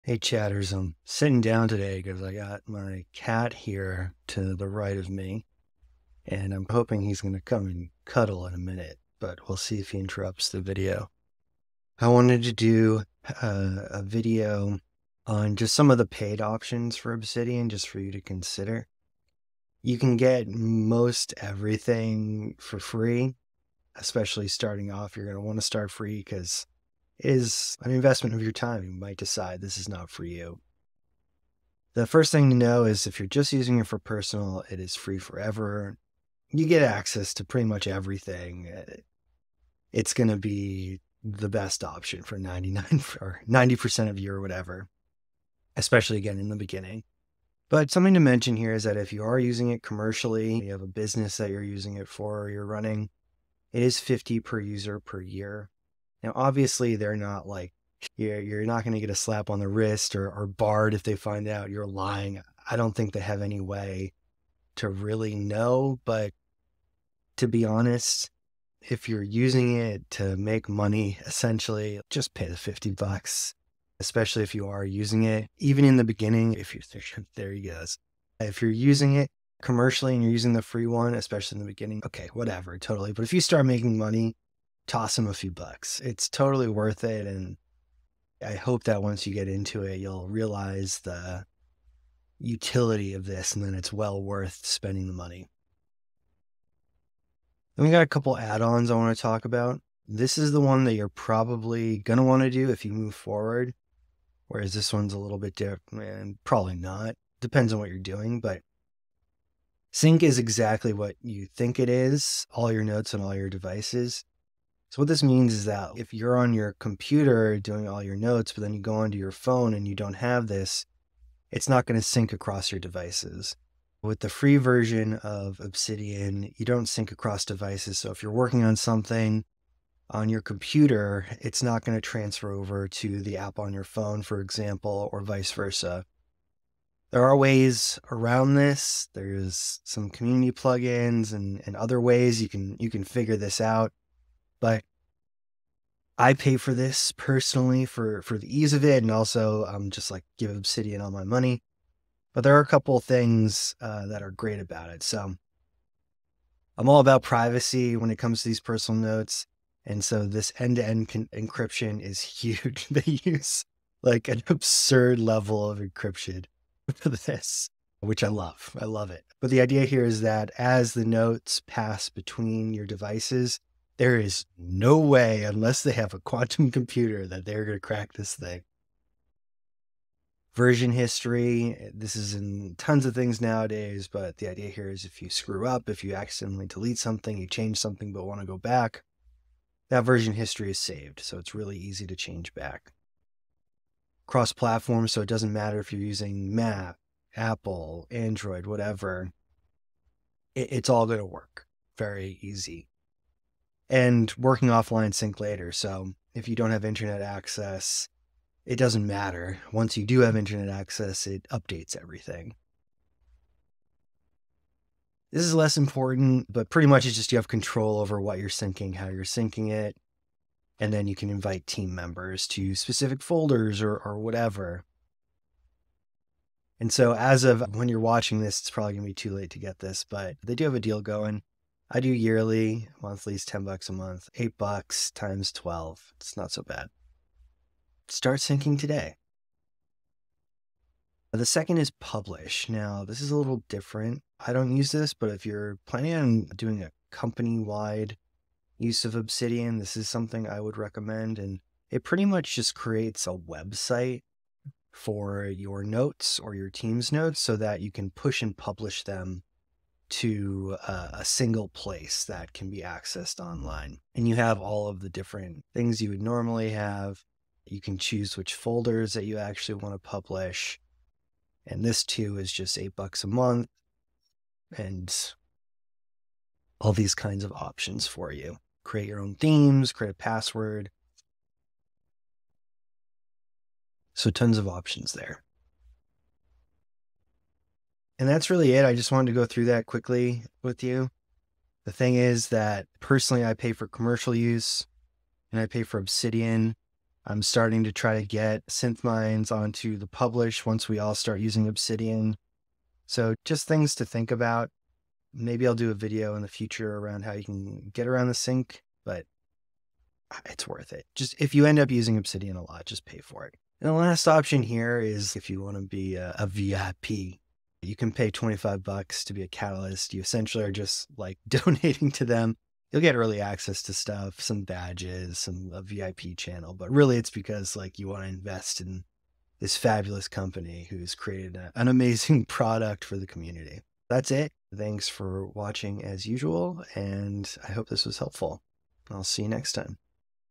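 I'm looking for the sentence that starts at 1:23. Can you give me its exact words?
But if you start making money, toss them a few bucks.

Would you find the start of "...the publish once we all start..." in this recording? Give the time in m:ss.
4:59.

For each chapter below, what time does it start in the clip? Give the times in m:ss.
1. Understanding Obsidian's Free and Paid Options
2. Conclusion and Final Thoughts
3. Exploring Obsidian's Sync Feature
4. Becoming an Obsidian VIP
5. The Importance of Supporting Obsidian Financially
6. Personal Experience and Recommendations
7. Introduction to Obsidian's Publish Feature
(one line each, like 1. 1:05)
1. 0:15
2. 5:34
3. 1:49
4. 5:13
5. 1:24
6. 4:51
7. 4:01.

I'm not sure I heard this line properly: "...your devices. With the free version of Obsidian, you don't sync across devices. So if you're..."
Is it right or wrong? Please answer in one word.
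right.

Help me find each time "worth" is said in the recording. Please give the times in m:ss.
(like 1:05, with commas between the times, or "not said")
1:26, 1:34, 5:10.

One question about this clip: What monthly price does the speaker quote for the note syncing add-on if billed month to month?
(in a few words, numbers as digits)
$10.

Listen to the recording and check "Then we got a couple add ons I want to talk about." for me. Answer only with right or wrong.
right.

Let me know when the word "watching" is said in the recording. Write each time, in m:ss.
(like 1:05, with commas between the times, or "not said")
3:47, 5:35.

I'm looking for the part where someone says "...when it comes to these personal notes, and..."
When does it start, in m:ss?
2:37.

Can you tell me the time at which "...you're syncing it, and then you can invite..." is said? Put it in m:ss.
3:39.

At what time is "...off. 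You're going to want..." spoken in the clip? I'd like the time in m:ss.
0:24.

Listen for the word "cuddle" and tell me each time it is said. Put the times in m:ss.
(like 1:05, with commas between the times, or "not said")
0:08.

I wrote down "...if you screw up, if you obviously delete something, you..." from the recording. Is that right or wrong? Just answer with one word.
wrong.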